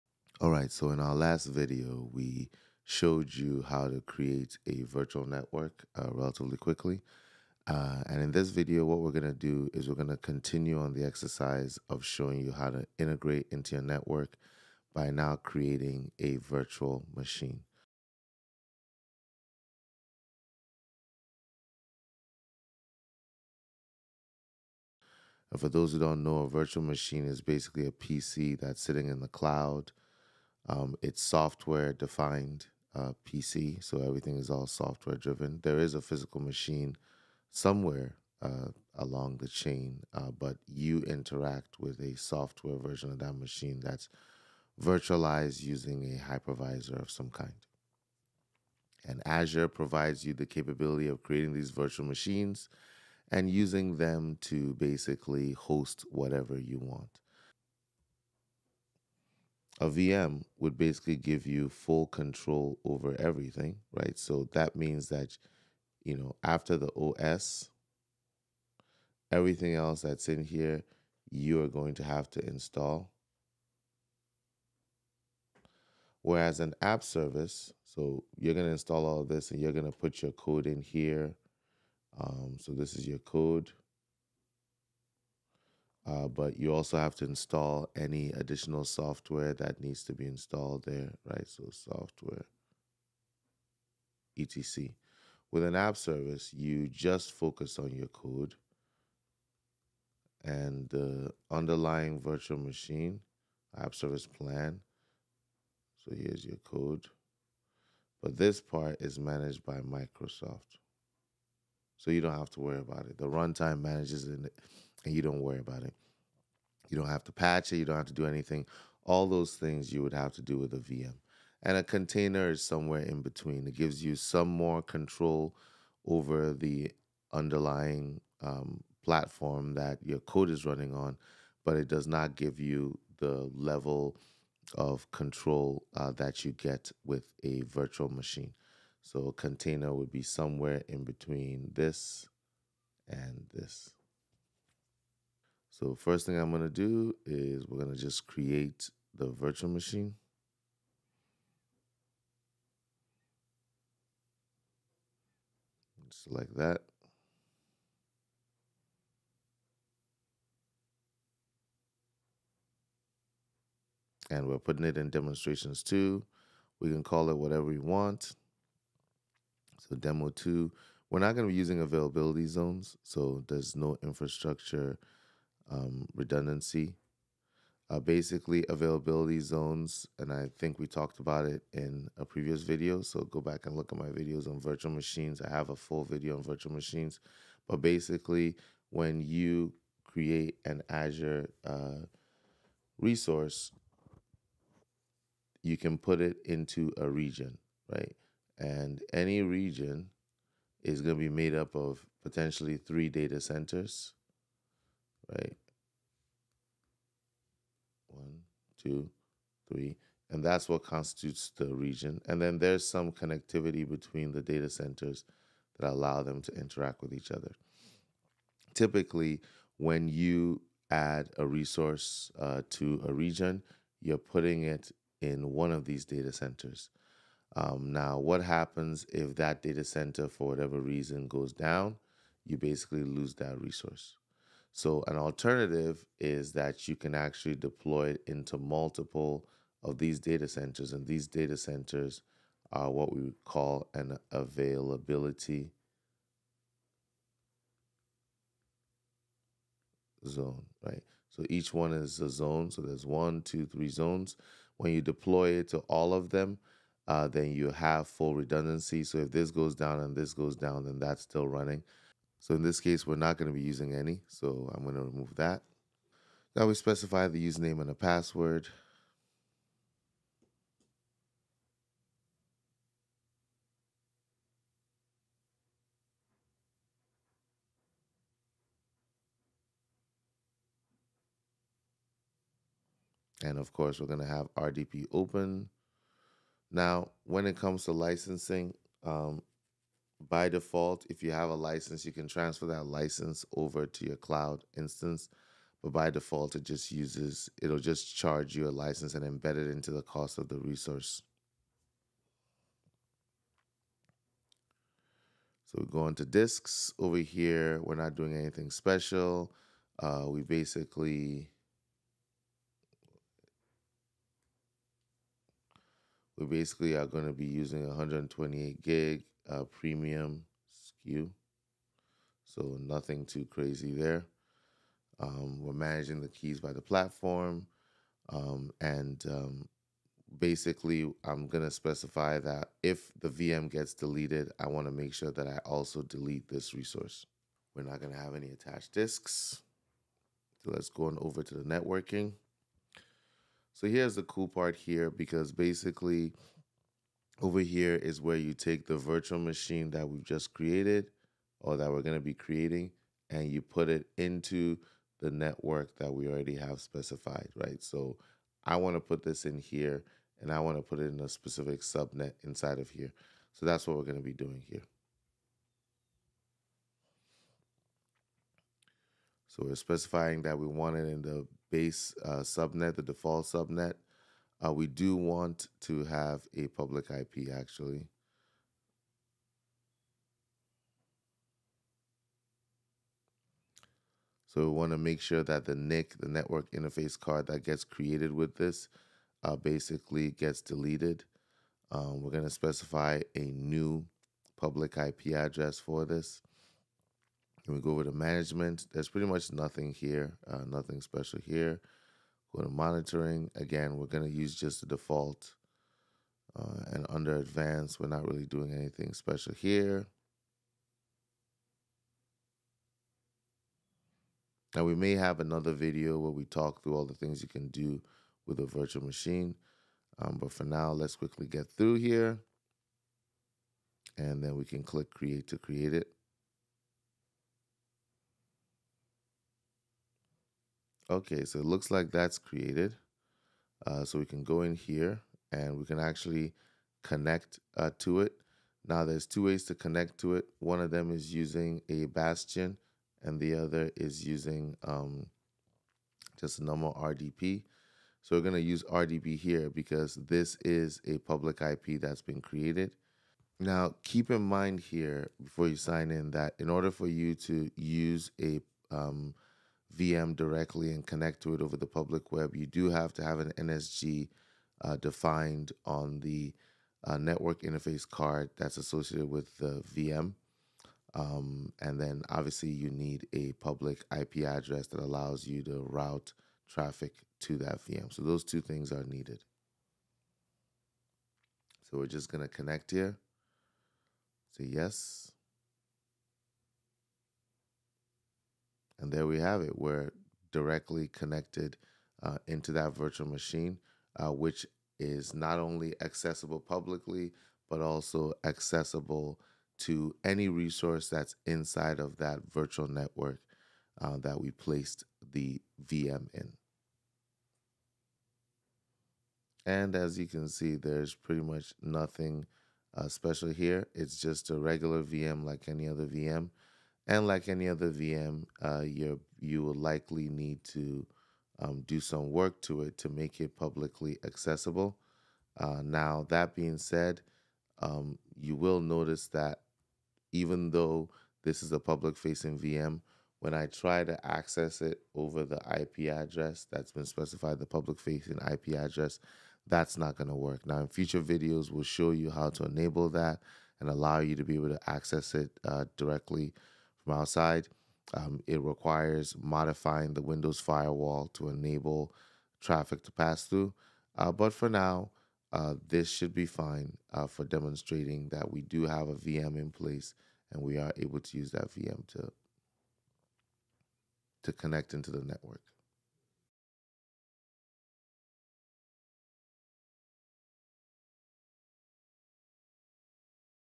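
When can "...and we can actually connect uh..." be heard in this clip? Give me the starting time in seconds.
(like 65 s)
435 s.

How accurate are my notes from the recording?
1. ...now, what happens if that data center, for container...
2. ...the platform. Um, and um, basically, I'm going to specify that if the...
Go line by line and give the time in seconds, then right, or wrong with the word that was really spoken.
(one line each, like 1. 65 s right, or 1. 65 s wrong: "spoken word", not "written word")
1. 227 s wrong: "whatever", not "container"
2. 326 s right.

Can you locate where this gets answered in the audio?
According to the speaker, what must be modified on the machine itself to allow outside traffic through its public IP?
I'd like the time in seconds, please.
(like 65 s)
550 s.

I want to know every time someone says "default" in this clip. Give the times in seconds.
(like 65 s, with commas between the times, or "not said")
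290 s, 296 s, 373 s, 404 s.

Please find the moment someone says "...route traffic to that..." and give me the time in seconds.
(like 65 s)
475 s.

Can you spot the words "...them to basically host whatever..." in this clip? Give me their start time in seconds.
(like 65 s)
53 s.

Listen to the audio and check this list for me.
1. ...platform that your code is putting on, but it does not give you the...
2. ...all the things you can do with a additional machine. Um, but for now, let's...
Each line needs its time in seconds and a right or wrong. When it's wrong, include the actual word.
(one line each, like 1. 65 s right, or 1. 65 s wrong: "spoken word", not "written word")
1. 129 s wrong: "running", not "putting"
2. 416 s wrong: "virtual", not "additional".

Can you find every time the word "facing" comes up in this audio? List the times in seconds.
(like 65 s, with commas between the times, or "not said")
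532 s, 537 s.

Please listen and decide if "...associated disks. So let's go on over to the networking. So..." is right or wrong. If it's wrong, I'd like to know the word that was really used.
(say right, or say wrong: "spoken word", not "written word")
wrong: "attached", not "associated".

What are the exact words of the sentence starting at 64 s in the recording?
So that means that, you know, after the OS, everything else that's in here, you are going to have to install.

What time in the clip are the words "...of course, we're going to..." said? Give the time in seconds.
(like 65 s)
283 s.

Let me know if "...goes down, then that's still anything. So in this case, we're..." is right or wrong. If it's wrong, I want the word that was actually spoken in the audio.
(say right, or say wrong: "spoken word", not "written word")
wrong: "running", not "anything".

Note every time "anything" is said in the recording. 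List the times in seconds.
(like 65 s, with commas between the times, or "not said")
118 s, 308 s, 408 s.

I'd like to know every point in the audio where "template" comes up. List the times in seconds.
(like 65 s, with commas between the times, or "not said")
not said.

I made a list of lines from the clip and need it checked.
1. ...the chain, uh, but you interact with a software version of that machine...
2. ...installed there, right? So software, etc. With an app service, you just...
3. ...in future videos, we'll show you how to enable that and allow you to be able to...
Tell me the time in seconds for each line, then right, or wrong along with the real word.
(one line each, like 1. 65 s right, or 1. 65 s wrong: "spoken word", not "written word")
1. 39 s right
2. 90 s right
3. 540 s right.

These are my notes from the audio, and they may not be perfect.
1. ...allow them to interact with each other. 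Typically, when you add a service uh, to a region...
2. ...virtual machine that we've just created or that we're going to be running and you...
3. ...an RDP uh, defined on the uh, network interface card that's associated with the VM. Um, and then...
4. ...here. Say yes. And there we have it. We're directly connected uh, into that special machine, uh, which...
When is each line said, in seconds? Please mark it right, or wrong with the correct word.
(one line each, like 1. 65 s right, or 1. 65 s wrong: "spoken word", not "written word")
1. 215 s wrong: "resource", not "service"
2. 348 s wrong: "creating", not "running"
3. 463 s wrong: "NSG", not "RDP"
4. 482 s wrong: "virtual", not "special".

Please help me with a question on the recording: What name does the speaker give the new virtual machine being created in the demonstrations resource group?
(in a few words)
demo two.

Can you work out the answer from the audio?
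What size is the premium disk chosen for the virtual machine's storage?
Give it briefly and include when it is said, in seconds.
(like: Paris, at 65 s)
128 gig, at 317 s.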